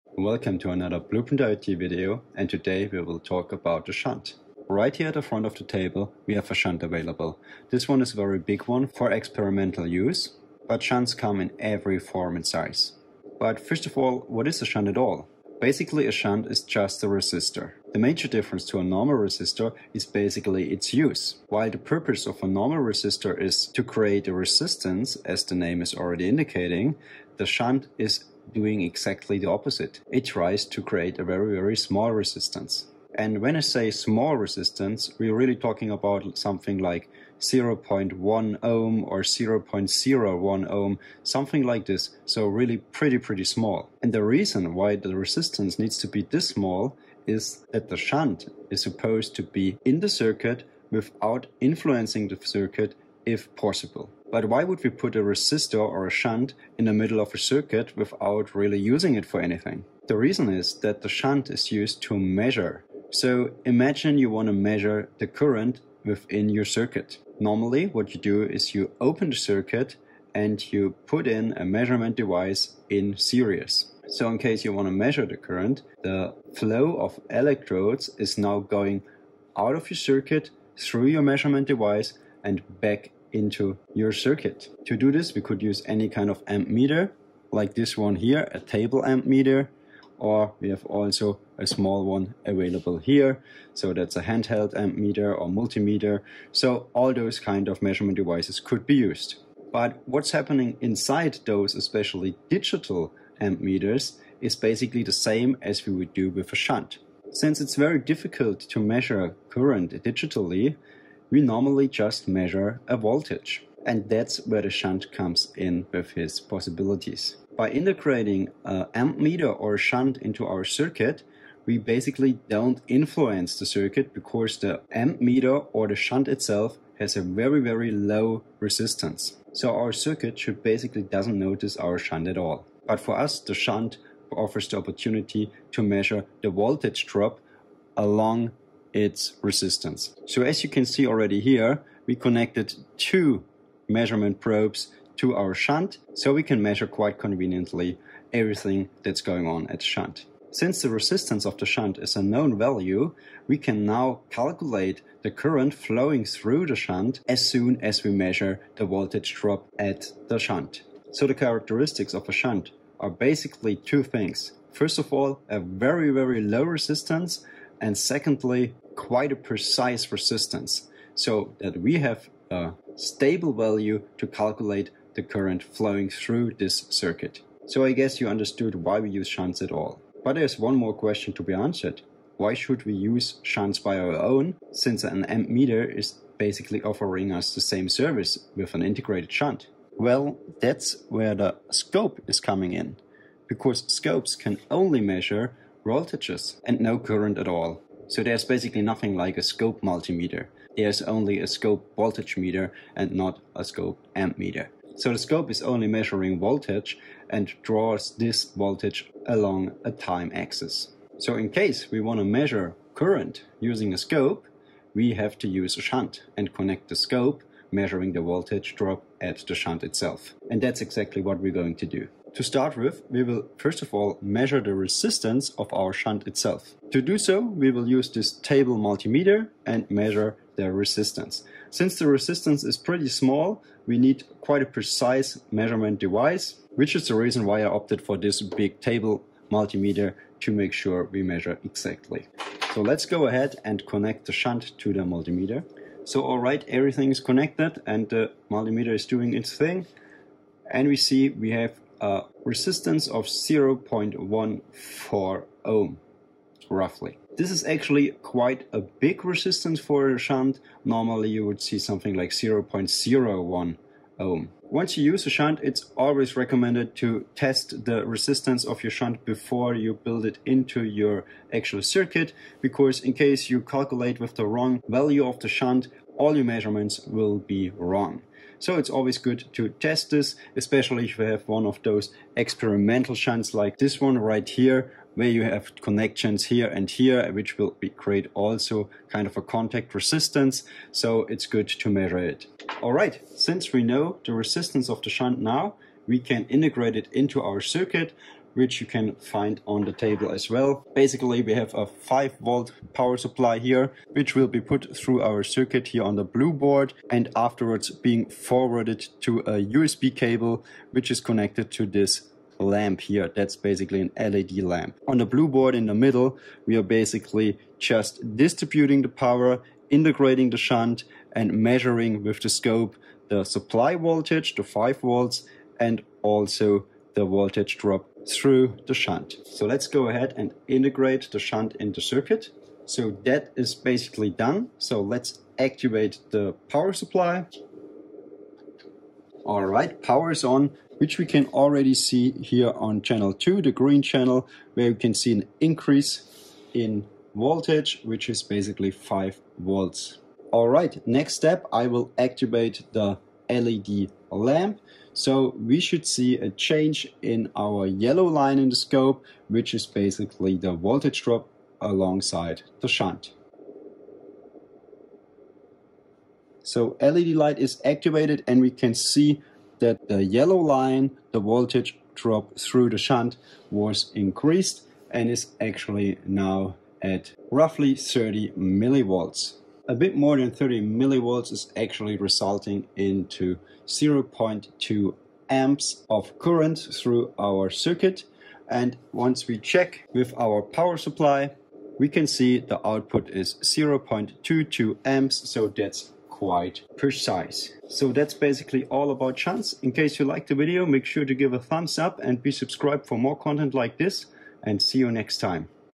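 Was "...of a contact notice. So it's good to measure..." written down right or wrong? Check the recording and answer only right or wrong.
wrong.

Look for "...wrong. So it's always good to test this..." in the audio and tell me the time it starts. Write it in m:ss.
4:37.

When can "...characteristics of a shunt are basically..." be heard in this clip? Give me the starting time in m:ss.
2:41.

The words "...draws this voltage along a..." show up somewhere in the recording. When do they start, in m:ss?
3:27.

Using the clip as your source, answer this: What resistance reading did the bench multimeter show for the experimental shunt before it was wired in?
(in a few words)
0.14 ohm.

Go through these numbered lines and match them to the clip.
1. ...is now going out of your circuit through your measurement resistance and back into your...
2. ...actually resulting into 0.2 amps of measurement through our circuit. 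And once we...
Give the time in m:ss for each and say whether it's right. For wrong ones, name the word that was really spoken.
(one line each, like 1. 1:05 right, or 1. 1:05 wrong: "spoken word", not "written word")
1. 1:18 wrong: "device", not "resistance"
2. 6:21 wrong: "current", not "measurement".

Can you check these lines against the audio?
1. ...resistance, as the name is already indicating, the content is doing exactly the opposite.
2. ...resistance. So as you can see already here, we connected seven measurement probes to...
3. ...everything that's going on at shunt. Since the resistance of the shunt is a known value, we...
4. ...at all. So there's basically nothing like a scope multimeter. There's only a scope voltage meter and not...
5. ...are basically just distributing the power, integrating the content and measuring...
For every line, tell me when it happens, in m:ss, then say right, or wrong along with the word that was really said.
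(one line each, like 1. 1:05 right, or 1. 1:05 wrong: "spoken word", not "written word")
1. 0:24 wrong: "shunt", not "content"
2. 2:19 wrong: "two", not "seven"
3. 2:28 right
4. 3:17 right
5. 5:16 wrong: "shunt", not "content".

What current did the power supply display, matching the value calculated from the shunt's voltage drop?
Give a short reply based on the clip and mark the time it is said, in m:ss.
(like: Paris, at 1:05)
0.22 amps, at 6:33.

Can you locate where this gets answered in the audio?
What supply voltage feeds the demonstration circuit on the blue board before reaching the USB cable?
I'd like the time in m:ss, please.
5:01.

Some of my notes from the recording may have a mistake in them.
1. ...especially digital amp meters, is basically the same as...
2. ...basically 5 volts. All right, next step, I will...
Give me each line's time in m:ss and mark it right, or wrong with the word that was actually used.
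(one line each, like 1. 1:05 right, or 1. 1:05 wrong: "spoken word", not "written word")
1. 1:41 right
2. 5:48 right.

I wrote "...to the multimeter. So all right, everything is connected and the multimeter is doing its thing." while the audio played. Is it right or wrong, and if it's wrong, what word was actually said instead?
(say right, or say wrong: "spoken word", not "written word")
right.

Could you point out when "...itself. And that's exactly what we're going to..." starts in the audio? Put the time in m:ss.
3:39.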